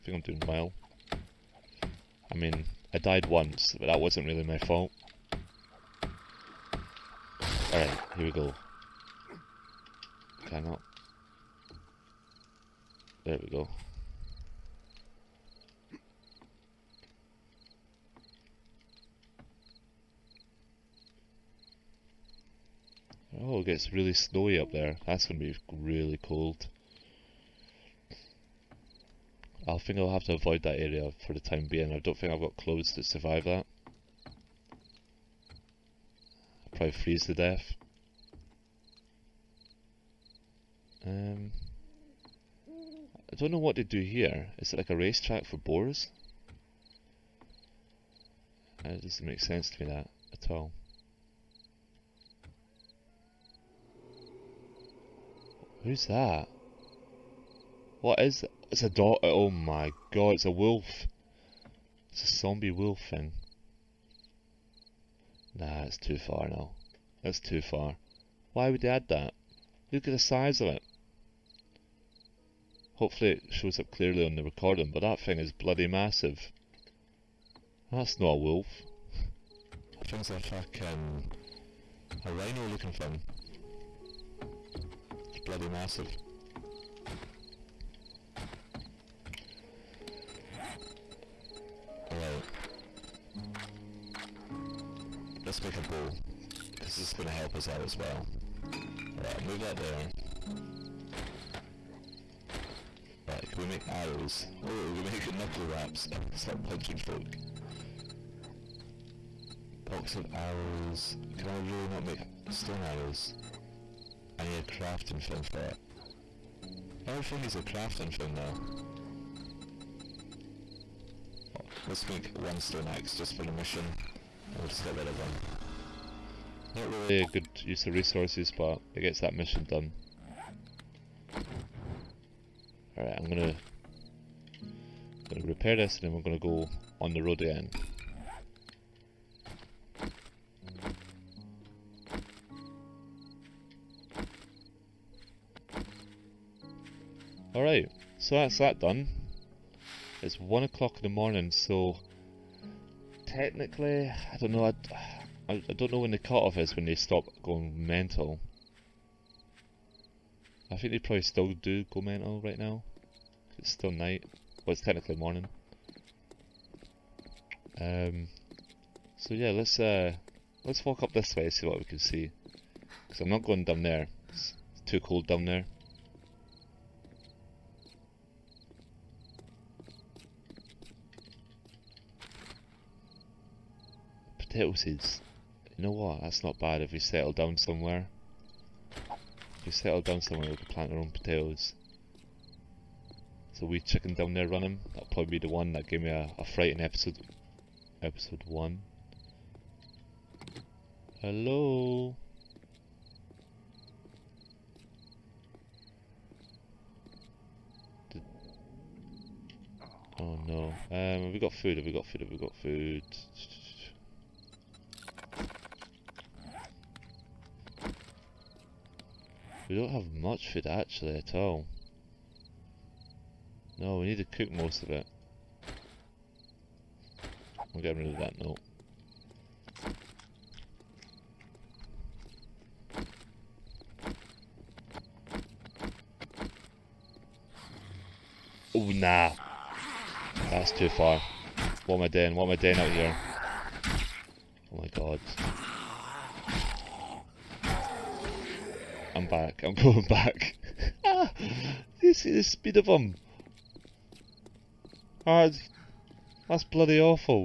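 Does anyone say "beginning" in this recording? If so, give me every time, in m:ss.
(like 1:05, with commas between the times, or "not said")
not said.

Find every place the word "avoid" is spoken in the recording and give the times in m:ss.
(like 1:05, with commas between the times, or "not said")
0:30.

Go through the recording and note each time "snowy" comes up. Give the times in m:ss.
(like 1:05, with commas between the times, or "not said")
0:24.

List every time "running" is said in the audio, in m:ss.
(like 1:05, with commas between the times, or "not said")
3:14.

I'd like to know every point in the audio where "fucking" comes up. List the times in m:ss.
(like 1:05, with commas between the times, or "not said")
1:20.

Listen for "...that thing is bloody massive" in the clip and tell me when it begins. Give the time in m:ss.
1:14.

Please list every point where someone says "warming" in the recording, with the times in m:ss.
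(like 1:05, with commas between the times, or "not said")
not said.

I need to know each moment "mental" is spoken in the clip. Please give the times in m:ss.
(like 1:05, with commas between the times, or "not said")
2:37, 2:42.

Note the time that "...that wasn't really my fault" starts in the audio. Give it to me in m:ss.
0:03.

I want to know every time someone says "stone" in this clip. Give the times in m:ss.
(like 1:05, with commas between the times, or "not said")
1:52, 2:02.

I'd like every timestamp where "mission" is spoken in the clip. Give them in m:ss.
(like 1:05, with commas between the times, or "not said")
2:03, 2:09.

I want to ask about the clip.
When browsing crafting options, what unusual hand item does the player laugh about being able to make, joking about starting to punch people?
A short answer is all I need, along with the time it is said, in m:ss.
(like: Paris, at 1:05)
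Knuckle wraps, at 1:45.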